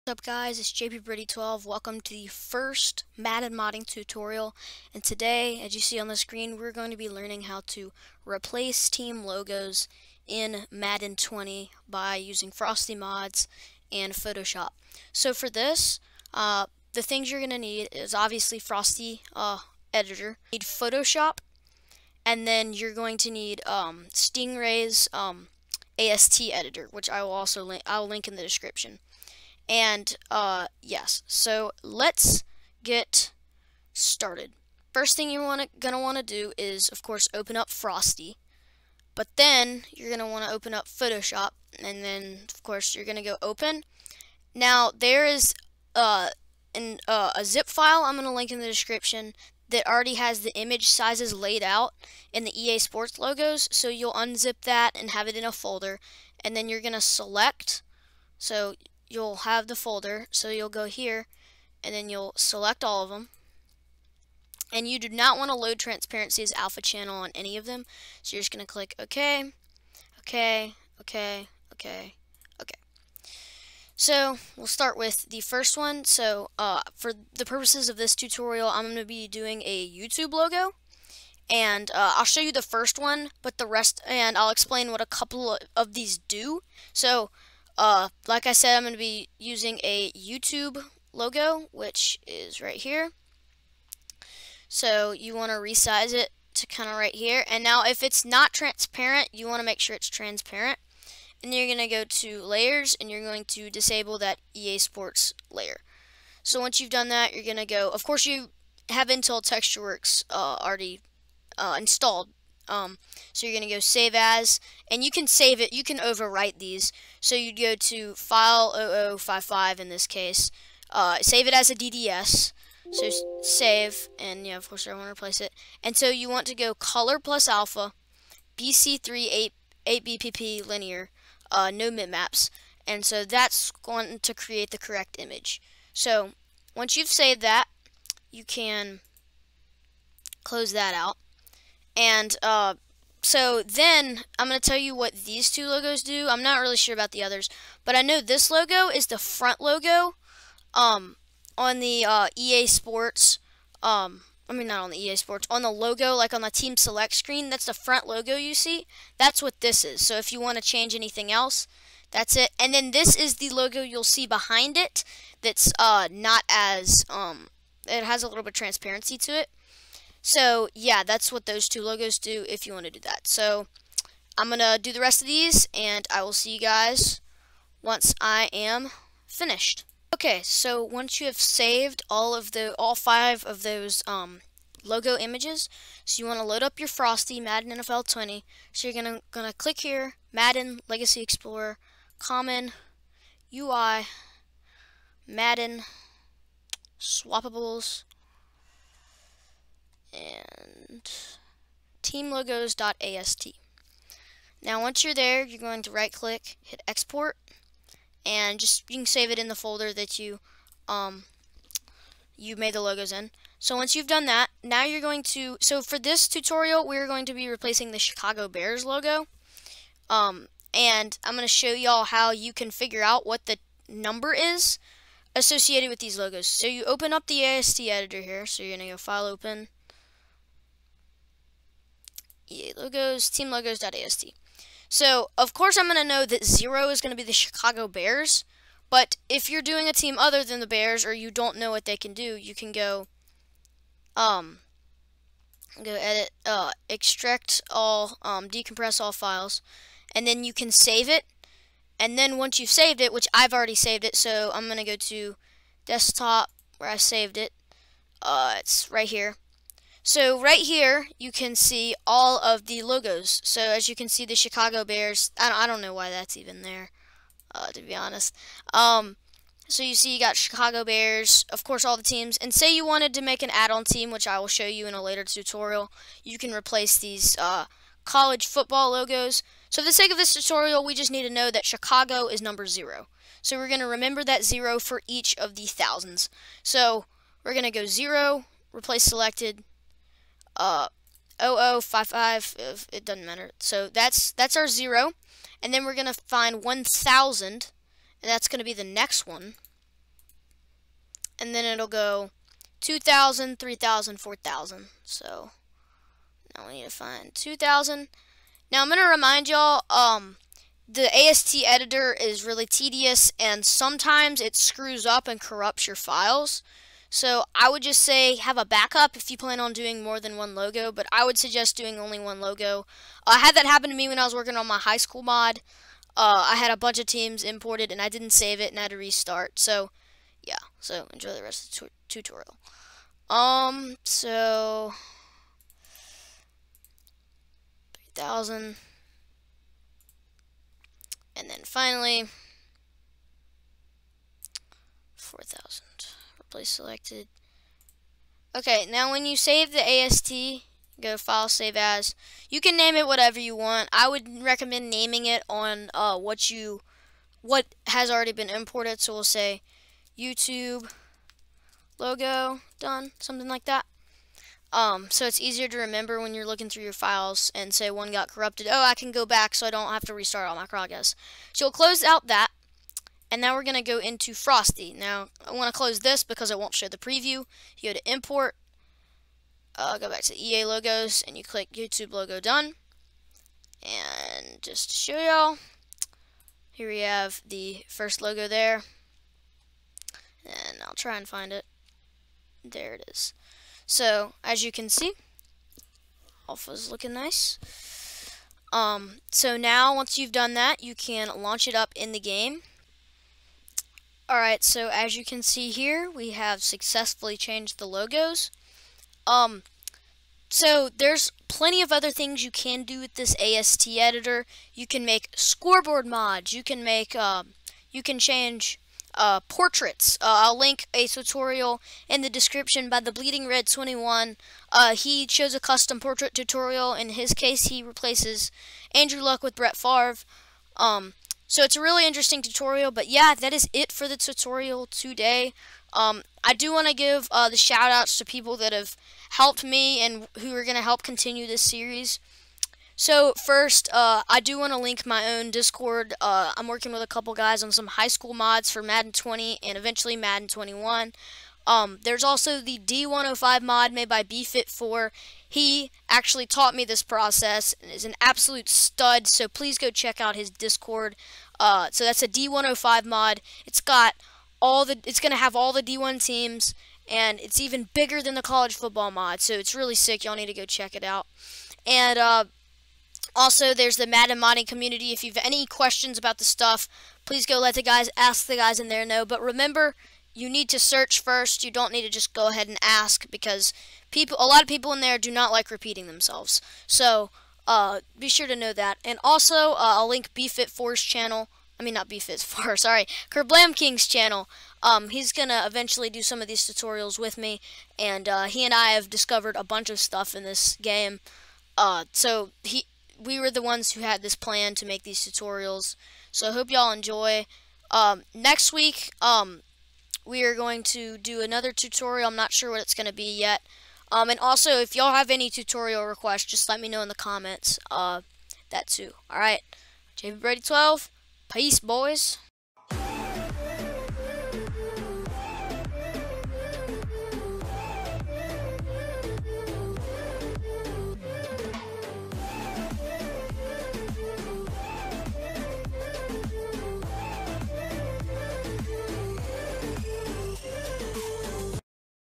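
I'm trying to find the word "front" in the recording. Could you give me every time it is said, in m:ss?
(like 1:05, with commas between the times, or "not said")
2:29, 2:37.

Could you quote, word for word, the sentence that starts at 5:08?
Now I'm going to remind y'all, um, the AST editor is really tedious, and sometimes it screws up and corrupts your files.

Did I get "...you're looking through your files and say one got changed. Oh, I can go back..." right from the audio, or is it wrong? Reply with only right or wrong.
wrong.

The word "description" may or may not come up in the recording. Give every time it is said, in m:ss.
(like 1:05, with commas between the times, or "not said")
0:28, 0:48, 7:02.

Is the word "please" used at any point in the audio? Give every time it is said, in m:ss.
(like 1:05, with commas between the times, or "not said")
7:39, 7:57.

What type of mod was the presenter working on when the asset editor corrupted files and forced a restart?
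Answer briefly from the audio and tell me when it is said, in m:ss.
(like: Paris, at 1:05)
High school mod, at 5:24.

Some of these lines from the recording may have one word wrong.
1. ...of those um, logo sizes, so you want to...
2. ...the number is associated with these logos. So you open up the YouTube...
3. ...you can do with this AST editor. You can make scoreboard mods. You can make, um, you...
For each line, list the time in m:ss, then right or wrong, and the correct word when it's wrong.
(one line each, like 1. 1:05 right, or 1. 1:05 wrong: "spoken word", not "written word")
1. 3:03 wrong: "images", not "sizes"
2. 3:43 wrong: "AST", not "YouTube"
3. 6:52 right.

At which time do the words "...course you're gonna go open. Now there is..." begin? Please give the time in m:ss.
0:42.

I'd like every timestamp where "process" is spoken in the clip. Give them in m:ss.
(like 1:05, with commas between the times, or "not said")
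7:37.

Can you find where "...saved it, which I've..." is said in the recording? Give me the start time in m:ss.
4:12.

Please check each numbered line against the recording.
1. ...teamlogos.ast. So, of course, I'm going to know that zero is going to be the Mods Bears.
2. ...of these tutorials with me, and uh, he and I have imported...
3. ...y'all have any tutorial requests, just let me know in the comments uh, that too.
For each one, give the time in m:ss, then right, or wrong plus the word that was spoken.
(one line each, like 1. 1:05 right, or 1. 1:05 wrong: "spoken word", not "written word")
1. 3:53 wrong: "Chicago", not "Mods"
2. 8:16 wrong: "discovered", not "imported"
3. 8:34 right.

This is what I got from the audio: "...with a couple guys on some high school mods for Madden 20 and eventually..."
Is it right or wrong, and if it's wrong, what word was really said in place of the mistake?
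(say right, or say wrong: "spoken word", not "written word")
right.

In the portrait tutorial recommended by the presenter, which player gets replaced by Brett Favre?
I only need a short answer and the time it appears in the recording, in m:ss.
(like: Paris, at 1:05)
Andrew Luck, at 7:08.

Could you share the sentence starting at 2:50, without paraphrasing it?
So yeah, that's what those two logos do if you want to do that.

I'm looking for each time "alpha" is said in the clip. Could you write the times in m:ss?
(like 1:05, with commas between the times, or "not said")
1:06, 2:07, 6:36.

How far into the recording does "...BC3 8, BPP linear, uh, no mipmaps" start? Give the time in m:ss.
2:08.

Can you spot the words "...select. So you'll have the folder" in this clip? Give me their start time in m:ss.
0:57.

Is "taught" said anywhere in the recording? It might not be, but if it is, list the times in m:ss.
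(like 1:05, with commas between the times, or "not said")
7:36.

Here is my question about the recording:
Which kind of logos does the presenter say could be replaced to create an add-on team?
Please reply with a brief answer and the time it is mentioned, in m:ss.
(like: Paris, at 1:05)
College football logos, at 4:38.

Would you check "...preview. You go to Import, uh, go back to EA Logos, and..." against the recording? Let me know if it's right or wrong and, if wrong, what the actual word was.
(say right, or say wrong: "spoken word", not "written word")
right.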